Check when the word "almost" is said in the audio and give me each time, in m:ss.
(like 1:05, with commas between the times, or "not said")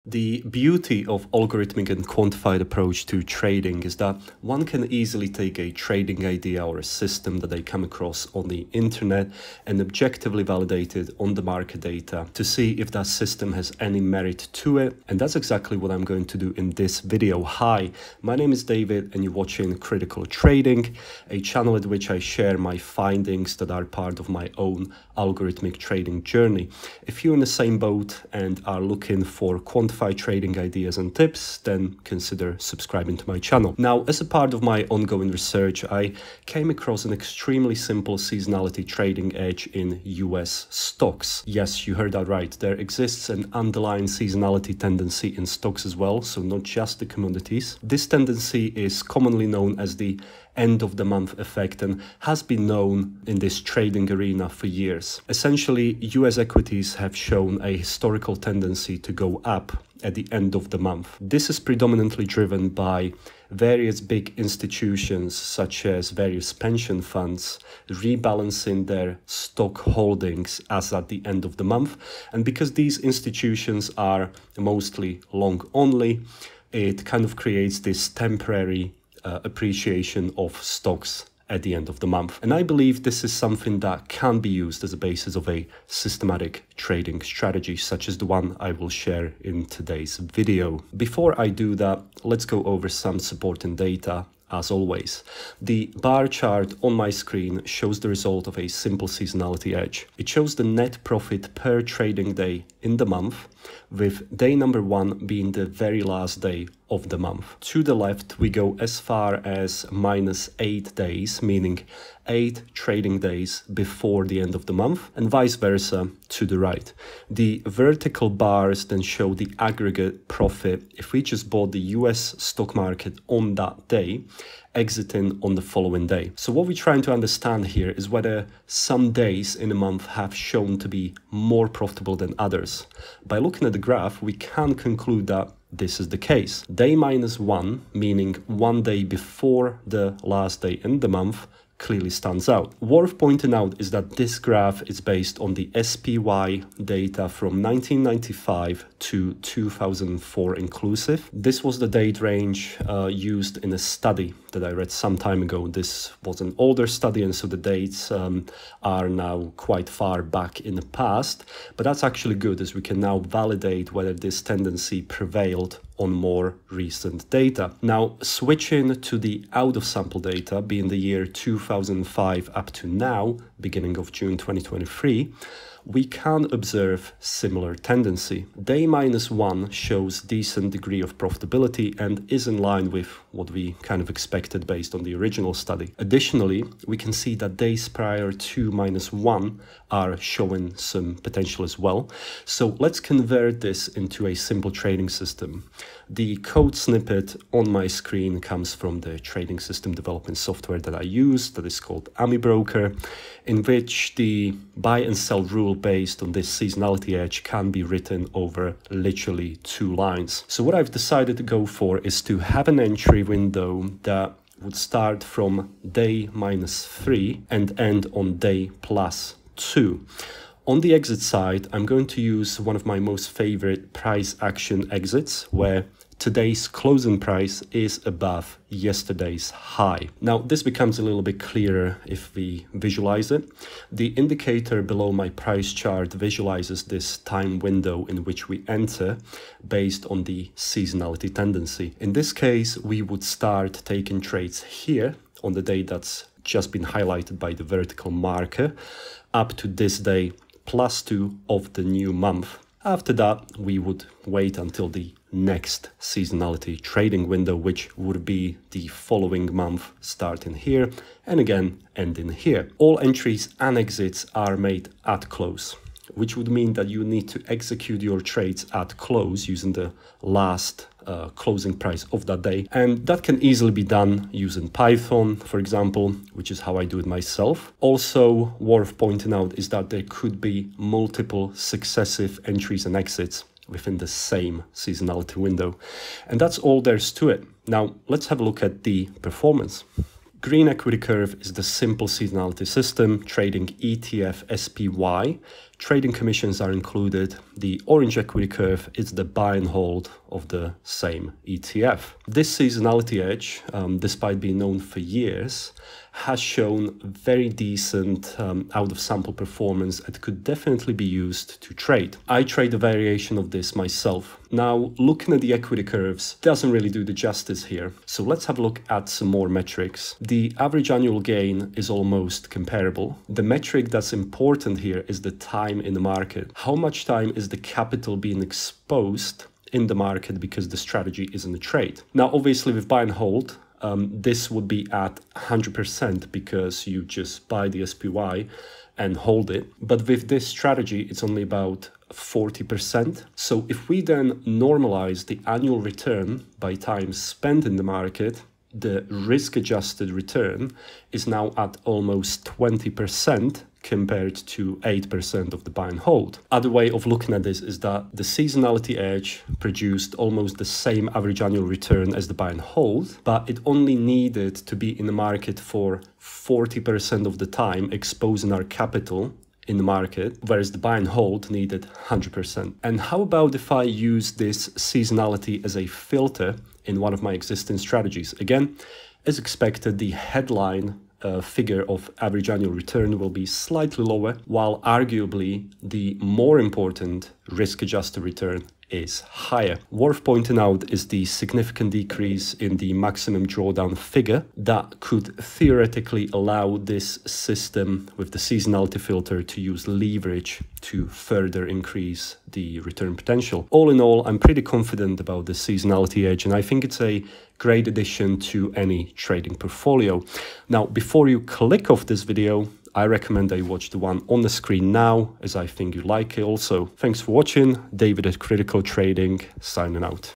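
5:21, 5:51, 6:00.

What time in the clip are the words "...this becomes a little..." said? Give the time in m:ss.
3:50.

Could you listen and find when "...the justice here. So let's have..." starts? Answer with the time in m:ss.
5:17.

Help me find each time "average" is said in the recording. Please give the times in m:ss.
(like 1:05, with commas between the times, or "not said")
5:20, 6:01, 6:22.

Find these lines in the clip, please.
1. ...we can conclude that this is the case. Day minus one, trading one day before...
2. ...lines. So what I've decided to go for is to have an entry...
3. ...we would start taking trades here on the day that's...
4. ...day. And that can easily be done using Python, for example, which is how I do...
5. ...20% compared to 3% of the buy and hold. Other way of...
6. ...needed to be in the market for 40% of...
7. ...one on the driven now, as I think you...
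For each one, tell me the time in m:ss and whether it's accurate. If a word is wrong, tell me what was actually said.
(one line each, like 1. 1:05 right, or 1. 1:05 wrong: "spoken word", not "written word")
1. 2:14 wrong: "meaning", not "trading"
2. 3:29 right
3. 4:02 right
4. 4:32 right
5. 5:52 wrong: "8", not "3"
6. 6:03 right
7. 6:53 wrong: "screen", not "driven".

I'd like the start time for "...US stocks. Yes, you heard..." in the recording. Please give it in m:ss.
0:40.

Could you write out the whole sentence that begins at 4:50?
Green equity curve is the simple seasonality system trading ETF SPY Trading commissions are included.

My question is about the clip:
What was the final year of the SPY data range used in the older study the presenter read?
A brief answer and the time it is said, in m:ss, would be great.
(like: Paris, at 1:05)
2004, at 2:29.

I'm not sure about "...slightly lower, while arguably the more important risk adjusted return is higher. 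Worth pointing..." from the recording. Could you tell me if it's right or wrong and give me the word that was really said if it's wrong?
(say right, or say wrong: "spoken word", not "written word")
right.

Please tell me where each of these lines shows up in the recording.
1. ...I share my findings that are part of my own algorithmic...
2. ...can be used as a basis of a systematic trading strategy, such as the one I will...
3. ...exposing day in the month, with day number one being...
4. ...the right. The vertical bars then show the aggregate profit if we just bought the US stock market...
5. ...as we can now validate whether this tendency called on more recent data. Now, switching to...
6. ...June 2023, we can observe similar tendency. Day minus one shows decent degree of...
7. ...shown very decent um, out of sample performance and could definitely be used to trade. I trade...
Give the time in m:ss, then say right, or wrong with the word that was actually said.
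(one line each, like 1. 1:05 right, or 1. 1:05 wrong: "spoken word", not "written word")
1. 0:22 right
2. 1:24 right
3. 1:41 wrong: "trading", not "exposing"
4. 1:56 right
5. 2:42 wrong: "prevailed", not "called"
6. 2:54 right
7. 5:06 right.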